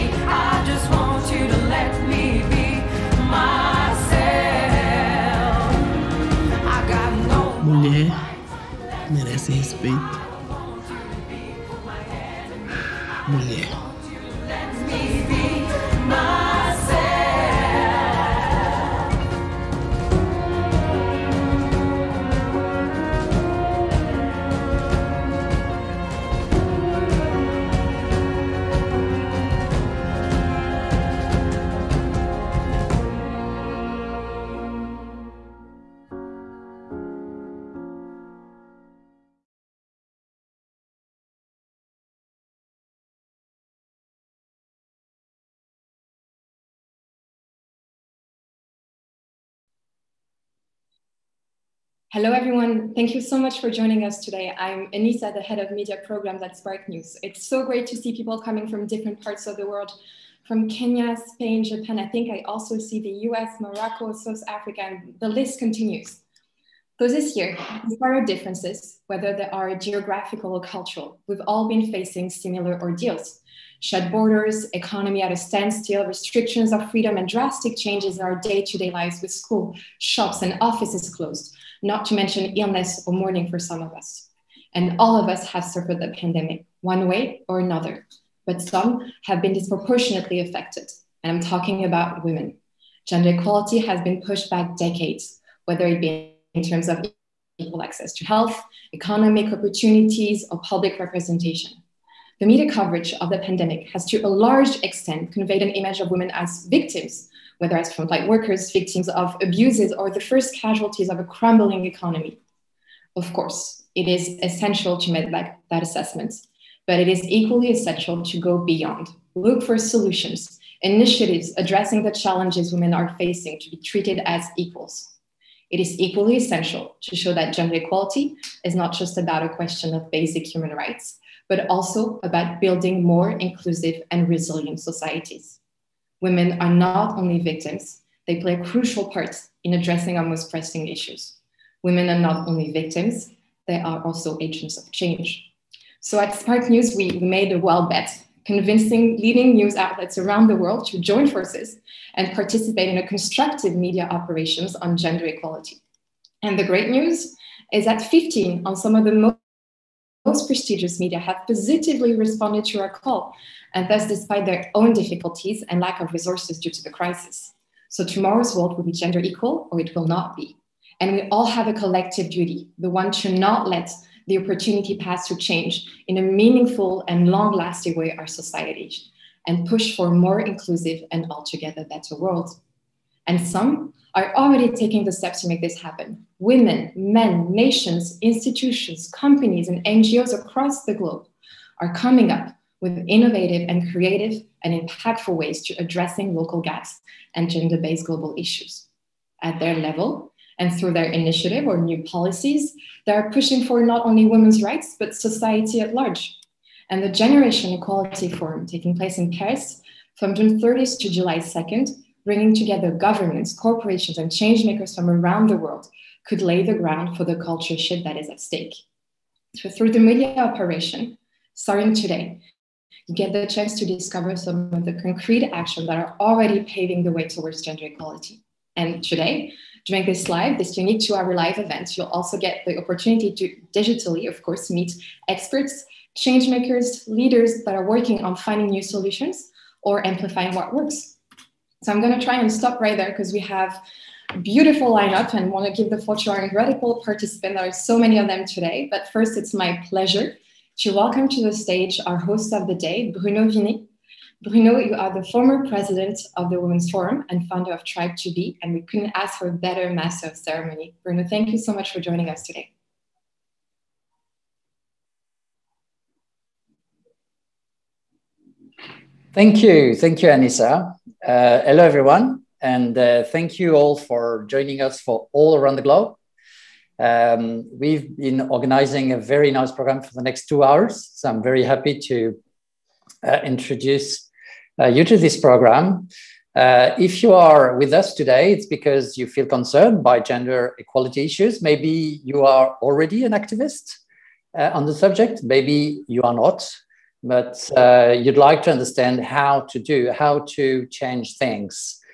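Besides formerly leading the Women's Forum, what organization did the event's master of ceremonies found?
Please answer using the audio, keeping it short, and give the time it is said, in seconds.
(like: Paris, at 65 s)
Tribe to Be, at 257 s.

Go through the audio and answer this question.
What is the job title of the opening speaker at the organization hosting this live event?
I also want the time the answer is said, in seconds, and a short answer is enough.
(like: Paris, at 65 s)
Head of media programs, at 55 s.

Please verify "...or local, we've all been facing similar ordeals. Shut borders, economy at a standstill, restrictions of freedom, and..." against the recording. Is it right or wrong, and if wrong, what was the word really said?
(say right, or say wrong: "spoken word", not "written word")
wrong: "cultural", not "local".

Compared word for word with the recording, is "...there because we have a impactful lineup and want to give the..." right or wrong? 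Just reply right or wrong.
wrong.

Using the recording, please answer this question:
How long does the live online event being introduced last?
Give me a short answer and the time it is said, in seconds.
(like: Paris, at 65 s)
Two hours, at 231 s.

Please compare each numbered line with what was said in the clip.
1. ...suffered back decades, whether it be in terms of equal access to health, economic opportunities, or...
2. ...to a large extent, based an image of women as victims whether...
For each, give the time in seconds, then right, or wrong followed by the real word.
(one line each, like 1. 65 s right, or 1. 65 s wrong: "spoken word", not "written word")
1. 94 s wrong: "pushed", not "suffered"
2. 104 s wrong: "conveyed", not "based".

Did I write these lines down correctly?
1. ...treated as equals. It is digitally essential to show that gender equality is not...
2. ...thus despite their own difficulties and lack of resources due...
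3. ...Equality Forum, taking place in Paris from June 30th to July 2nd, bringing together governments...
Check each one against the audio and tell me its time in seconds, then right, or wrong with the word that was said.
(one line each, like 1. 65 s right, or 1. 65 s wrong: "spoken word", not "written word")
1. 123 s wrong: "equally", not "digitally"
2. 163 s right
3. 207 s right.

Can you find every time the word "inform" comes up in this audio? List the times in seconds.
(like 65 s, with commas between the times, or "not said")
not said.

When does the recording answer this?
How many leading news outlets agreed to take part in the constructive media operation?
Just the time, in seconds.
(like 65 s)
158 s.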